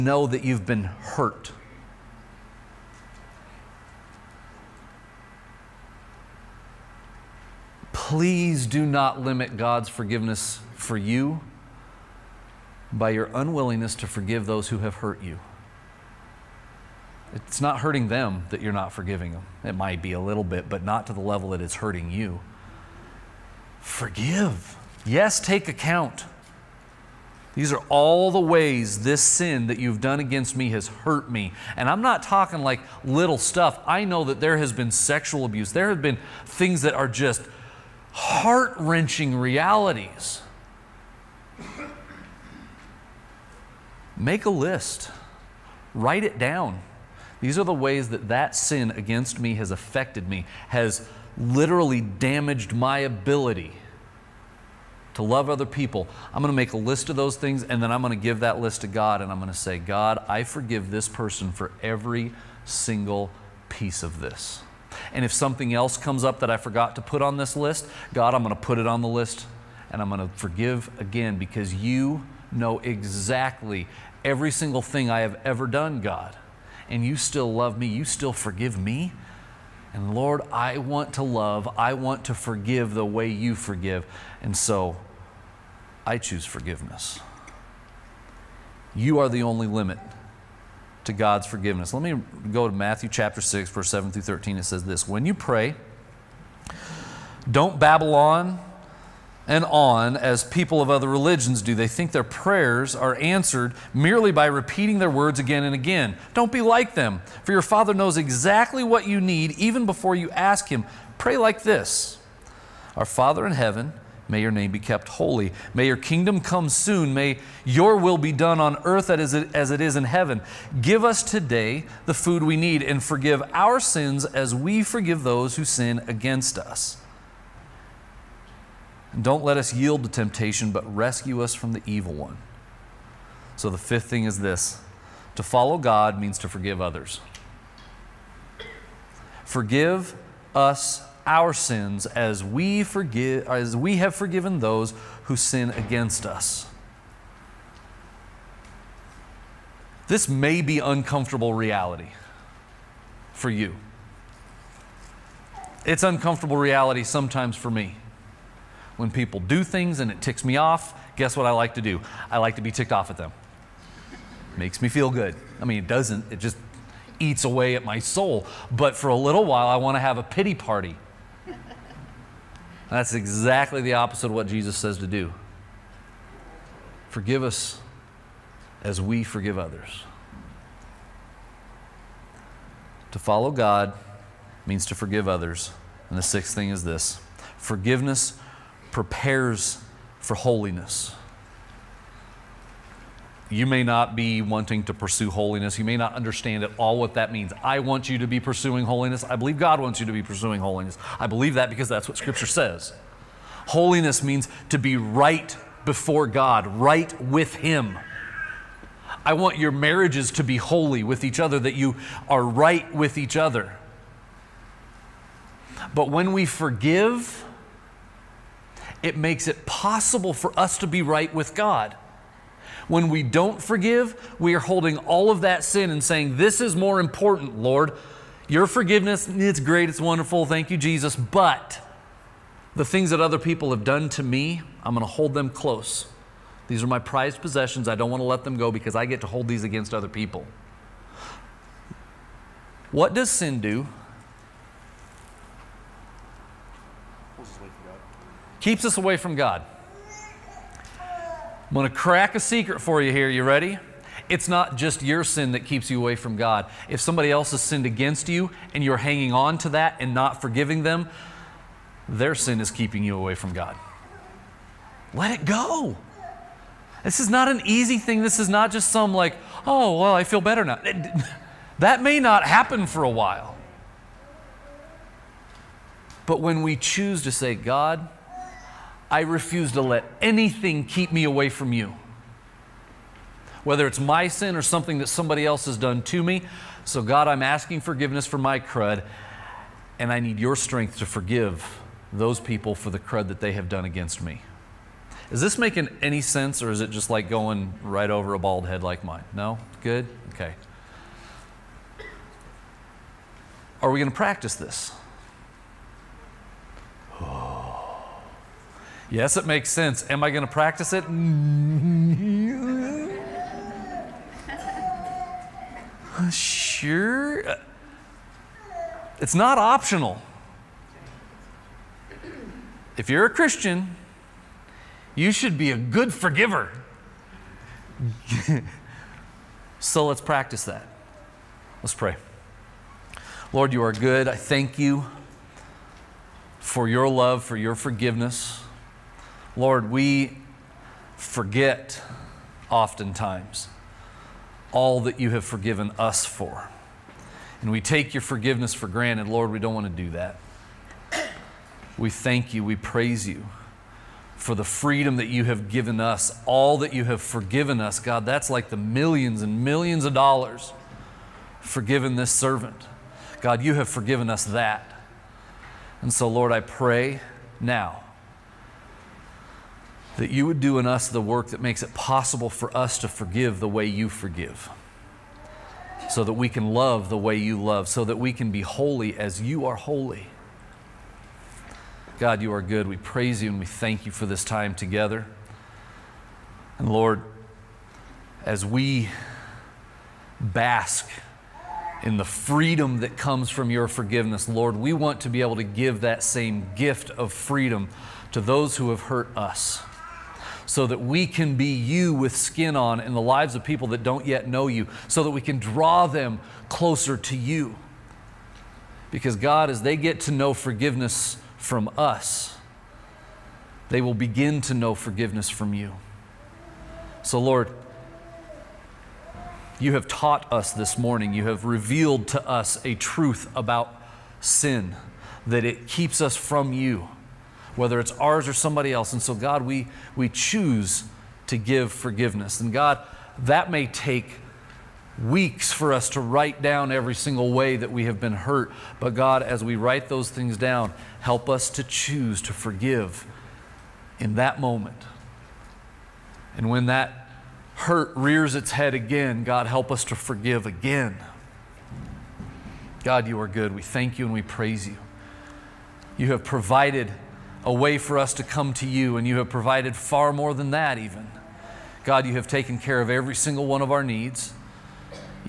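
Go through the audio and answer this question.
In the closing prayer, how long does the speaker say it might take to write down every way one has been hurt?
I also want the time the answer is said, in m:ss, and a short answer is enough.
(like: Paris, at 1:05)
Weeks, at 7:15.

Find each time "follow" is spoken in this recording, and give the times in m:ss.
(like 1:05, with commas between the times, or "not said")
2:15, 3:03.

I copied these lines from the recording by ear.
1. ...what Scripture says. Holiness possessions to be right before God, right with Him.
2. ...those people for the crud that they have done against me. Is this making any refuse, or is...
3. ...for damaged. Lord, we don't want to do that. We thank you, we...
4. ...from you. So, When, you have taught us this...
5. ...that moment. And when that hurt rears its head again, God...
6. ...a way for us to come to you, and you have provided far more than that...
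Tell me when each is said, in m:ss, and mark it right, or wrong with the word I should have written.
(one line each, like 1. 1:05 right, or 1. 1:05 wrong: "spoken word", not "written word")
1. 3:22 wrong: "means", not "possessions"
2. 4:52 wrong: "sense", not "refuse"
3. 5:48 wrong: "granted", not "damaged"
4. 6:55 wrong: "Lord", not "When"
5. 7:24 right
6. 7:37 right.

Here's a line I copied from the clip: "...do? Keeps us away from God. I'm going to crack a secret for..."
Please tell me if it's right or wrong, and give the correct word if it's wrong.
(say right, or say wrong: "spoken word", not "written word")
right.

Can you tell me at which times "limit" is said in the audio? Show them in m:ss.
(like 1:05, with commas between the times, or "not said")
0:09, 1:29.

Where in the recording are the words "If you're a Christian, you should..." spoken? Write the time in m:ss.
5:22.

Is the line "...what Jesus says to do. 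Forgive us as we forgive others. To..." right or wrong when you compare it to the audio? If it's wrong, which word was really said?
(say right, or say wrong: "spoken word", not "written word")
right.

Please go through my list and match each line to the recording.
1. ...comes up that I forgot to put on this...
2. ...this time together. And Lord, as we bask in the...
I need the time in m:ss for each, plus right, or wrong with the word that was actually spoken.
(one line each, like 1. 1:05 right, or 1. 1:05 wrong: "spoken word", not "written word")
1. 1:05 right
2. 6:24 right.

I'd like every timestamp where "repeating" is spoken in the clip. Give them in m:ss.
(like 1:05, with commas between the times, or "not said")
1:44.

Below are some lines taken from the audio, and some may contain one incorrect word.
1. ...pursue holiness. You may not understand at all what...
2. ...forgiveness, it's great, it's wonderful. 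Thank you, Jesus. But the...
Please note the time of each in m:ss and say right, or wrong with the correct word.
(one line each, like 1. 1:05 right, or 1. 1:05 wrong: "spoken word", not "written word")
1. 3:14 right
2. 3:48 right.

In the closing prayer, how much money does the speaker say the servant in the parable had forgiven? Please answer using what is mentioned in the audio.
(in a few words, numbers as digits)
Millions and millions of dollars.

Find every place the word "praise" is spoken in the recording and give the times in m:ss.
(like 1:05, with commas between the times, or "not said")
5:52, 6:22, 7:34.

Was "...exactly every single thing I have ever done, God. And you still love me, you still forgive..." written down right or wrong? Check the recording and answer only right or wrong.
right.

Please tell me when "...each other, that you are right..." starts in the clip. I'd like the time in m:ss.
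3:31.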